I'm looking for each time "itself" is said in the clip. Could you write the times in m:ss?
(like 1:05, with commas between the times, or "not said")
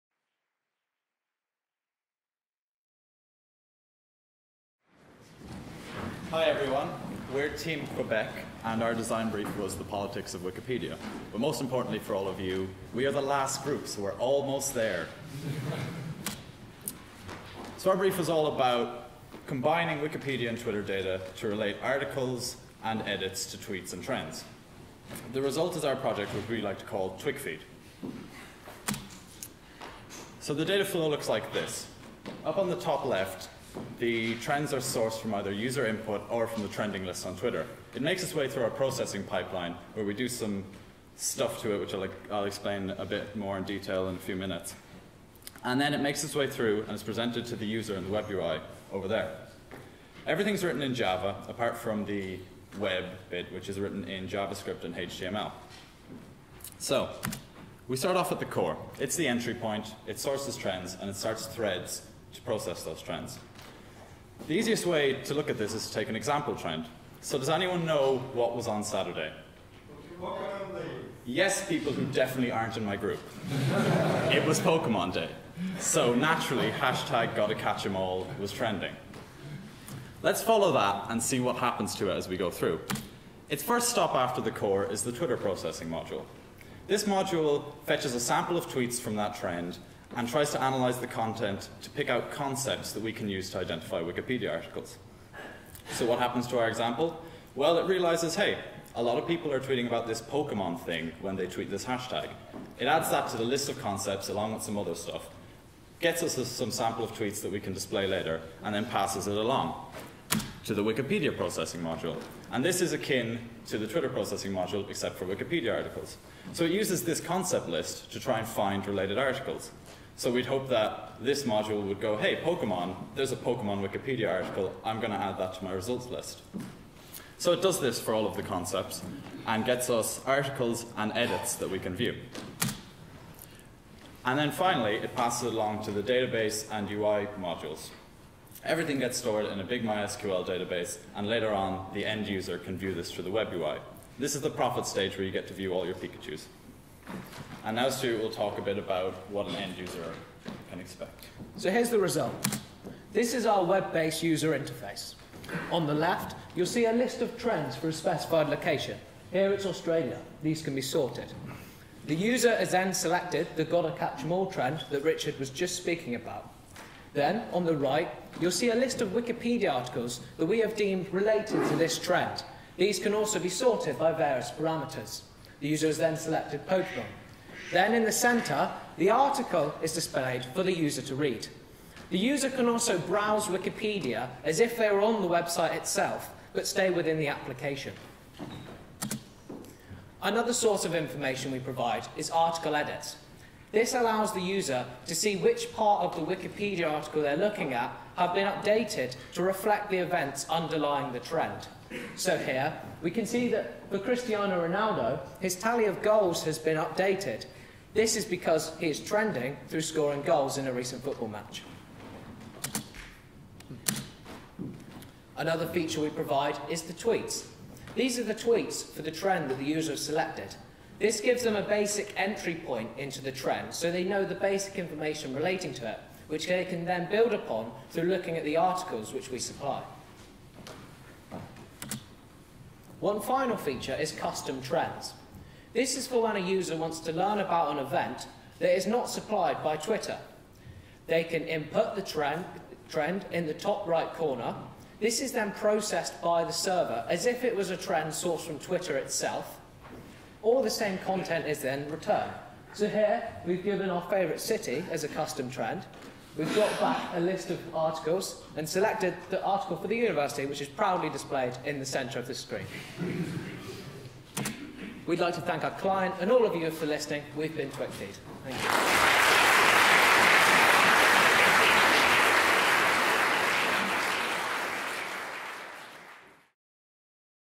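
3:05, 4:08.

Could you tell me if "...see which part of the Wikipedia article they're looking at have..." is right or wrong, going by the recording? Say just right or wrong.
right.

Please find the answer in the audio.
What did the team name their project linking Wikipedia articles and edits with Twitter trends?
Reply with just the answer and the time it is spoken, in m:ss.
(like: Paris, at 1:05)
TwigFeed, at 0:27.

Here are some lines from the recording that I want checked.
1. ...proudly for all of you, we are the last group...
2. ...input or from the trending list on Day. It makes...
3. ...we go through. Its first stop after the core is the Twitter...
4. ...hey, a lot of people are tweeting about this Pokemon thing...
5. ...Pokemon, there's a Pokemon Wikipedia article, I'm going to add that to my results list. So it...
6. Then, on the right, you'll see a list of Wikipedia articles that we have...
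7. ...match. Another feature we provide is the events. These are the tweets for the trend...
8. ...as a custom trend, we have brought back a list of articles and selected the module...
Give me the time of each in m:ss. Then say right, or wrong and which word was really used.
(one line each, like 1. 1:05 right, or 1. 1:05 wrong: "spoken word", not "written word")
1. 0:11 wrong: "importantly", not "proudly"
2. 0:35 wrong: "Twitter", not "Day"
3. 1:22 right
4. 1:38 right
5. 2:02 right
6. 2:47 right
7. 3:31 wrong: "tweets", not "events"
8. 4:14 wrong: "article", not "module".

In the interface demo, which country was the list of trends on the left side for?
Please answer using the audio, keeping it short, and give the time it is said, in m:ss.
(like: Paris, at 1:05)
Australia, at 2:39.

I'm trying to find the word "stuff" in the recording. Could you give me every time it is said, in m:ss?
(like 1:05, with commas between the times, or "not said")
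0:41, 1:44.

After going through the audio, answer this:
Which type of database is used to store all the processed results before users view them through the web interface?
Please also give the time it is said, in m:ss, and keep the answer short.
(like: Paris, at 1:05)
MySQL, at 2:19.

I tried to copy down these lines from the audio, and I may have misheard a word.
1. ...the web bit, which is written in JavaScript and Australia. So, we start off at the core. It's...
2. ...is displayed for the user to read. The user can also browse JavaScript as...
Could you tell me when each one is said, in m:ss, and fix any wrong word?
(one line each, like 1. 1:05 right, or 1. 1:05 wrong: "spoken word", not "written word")
1. 0:52 wrong: "HTML", not "Australia"
2. 2:59 wrong: "Wikipedia", not "JavaScript".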